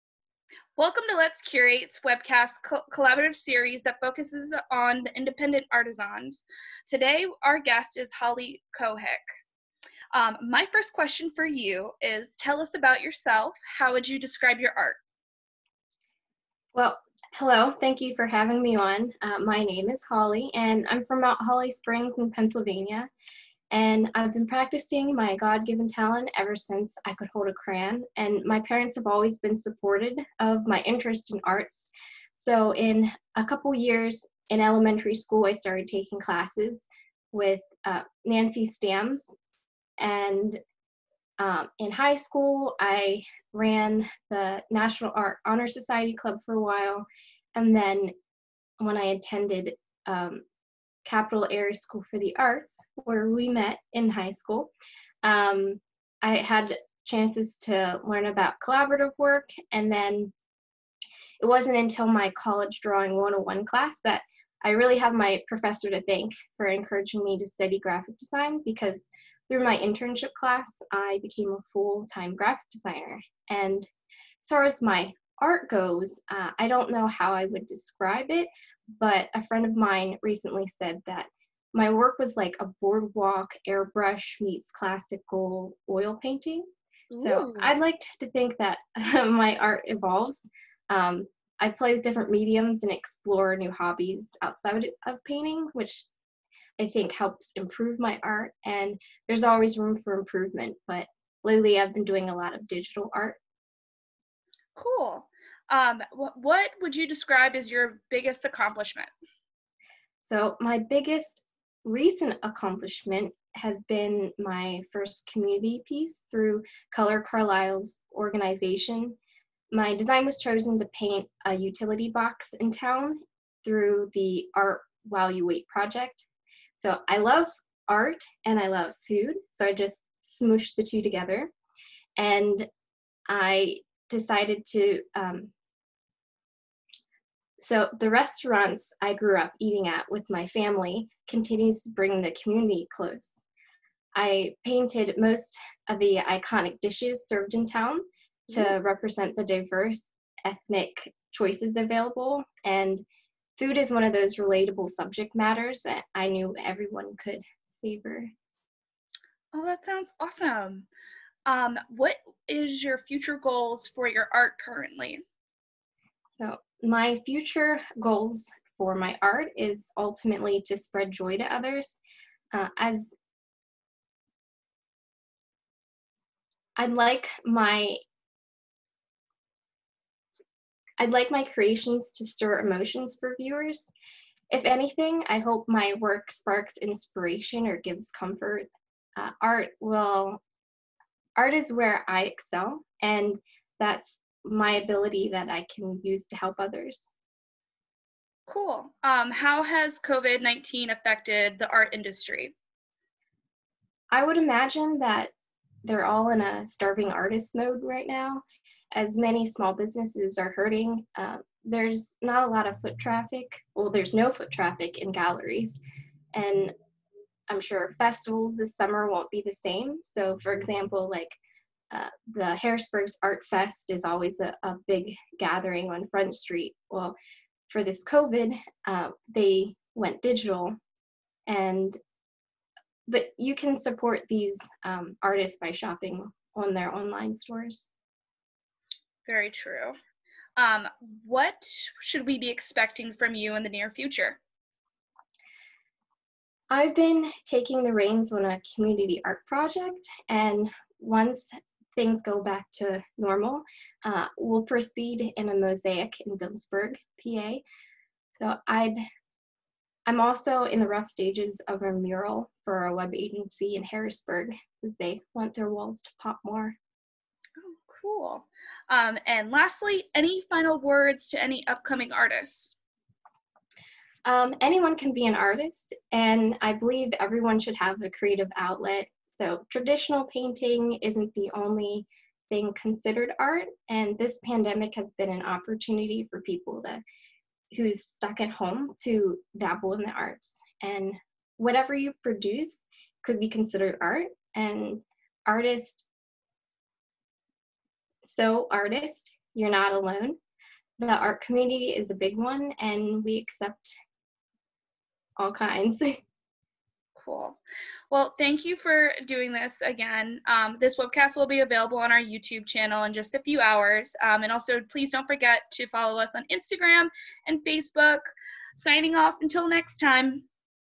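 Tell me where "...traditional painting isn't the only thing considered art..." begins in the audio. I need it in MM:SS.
04:39.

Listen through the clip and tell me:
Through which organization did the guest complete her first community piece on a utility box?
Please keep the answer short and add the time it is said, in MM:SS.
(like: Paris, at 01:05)
Color Carlisle, at 01:56.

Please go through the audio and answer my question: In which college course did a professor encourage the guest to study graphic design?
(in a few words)
Drawing 101.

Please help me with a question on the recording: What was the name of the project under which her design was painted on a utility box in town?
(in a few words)
Art While You Wait.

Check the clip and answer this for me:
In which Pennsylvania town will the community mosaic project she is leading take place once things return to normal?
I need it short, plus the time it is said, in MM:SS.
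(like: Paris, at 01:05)
Dillsburg, at 04:16.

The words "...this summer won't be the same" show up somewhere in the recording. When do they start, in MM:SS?
03:38.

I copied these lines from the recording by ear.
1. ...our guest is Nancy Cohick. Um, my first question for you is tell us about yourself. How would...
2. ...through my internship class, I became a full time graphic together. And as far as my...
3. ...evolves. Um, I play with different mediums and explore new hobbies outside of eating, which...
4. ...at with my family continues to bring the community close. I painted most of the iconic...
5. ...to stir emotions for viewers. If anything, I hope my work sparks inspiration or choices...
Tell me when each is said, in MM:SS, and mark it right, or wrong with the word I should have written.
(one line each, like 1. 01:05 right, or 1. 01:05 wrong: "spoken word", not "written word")
1. 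00:07 wrong: "Holly", not "Nancy"
2. 01:09 wrong: "designer", not "together"
3. 01:29 wrong: "painting", not "eating"
4. 02:19 right
5. 03:02 wrong: "gives", not "choices".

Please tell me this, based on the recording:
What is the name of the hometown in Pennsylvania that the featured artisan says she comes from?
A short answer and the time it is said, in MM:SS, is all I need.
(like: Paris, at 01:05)
Mount Holly Springs, at 00:21.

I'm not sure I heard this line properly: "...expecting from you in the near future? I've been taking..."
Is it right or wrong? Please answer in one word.
right.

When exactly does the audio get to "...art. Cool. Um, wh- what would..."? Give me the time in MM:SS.
01:43.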